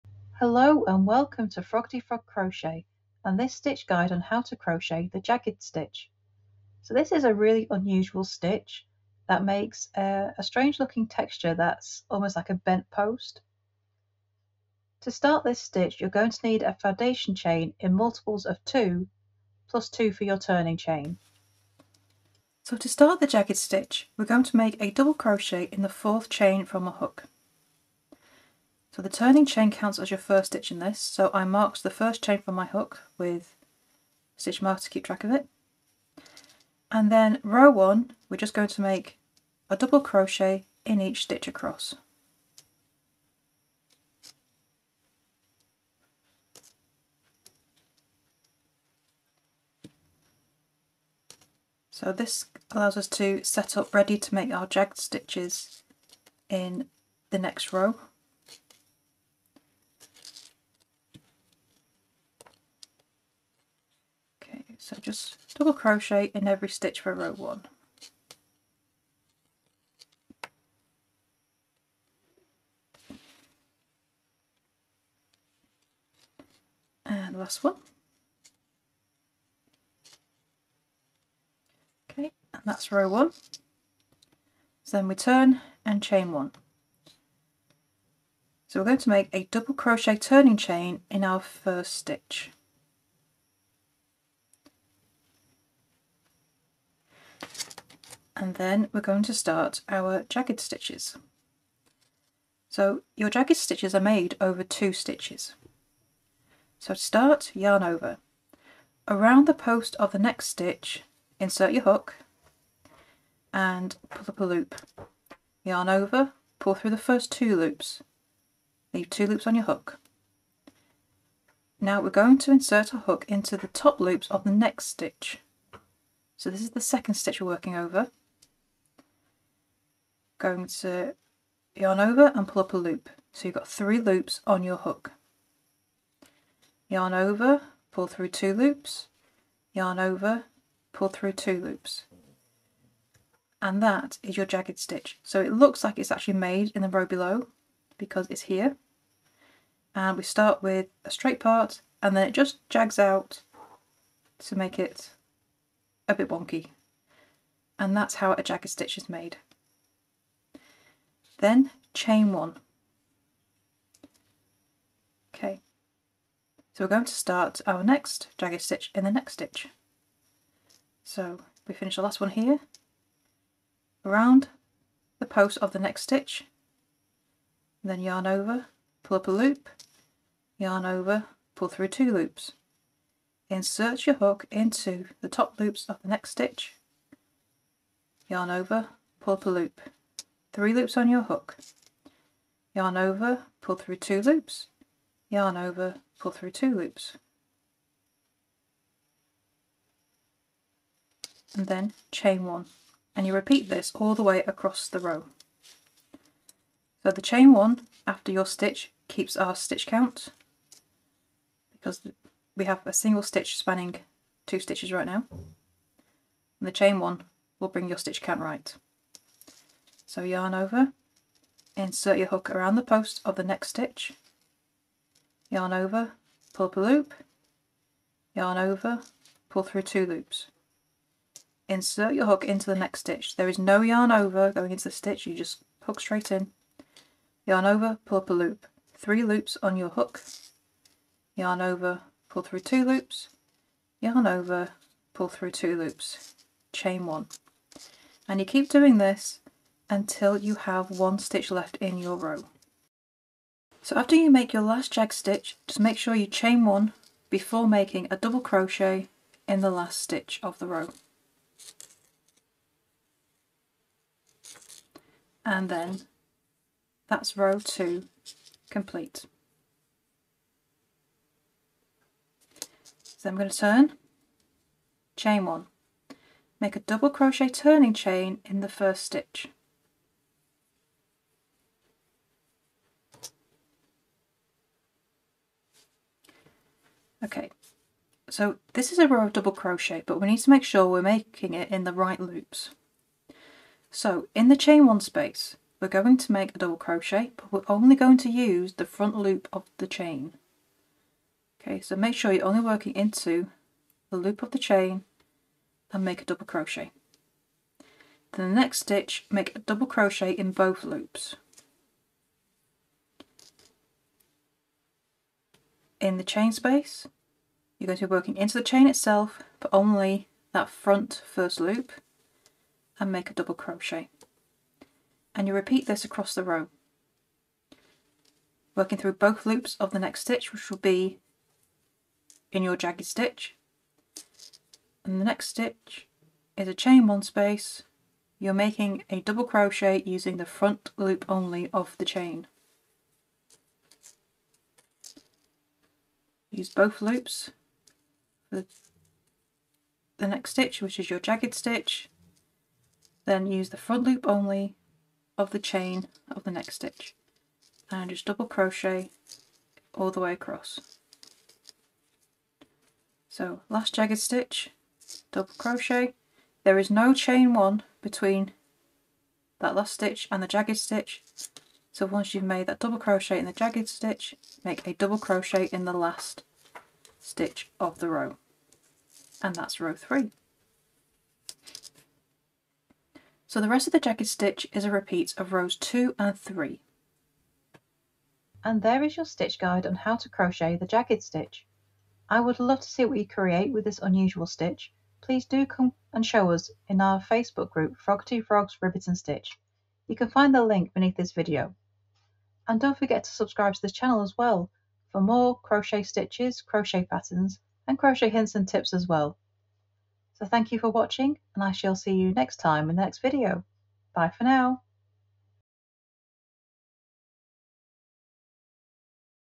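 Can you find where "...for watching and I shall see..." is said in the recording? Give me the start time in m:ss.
6:50.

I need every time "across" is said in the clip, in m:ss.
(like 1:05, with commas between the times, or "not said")
0:41, 3:24, 5:26, 6:00.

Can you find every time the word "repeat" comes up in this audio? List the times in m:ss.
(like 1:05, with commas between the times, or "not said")
3:23, 5:25, 6:24.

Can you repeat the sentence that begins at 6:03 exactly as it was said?
So last jagged stitch, double crochet.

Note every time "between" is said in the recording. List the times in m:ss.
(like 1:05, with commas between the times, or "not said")
6:08.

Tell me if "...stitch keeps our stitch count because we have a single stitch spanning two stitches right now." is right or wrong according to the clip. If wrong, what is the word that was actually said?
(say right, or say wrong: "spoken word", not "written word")
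right.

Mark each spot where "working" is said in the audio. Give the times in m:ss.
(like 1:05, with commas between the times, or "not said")
2:07, 5:02, 5:18, 5:28.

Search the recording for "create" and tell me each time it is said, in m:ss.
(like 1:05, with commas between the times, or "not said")
6:33.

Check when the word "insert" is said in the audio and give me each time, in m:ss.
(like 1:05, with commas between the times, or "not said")
1:51, 2:02, 3:03, 3:41, 3:51.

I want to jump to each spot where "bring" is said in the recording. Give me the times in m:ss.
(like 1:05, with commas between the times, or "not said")
3:37.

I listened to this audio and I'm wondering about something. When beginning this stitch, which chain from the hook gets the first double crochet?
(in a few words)
fourth.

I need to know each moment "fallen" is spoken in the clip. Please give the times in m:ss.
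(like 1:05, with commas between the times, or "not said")
not said.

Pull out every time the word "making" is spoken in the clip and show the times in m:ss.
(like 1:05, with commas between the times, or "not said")
4:17, 4:51, 5:38.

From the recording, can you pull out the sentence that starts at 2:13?
So you've got three loops on your hook.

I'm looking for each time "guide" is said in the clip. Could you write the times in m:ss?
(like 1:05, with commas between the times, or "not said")
0:03, 6:29.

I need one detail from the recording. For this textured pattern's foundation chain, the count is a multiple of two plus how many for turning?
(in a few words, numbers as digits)
2.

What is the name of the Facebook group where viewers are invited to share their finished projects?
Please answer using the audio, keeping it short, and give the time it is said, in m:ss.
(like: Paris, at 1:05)
Froggity Frogs Ribbit and Stitch, at 6:37.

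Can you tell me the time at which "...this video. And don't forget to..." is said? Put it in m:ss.
6:41.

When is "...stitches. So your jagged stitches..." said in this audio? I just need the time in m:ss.
1:40.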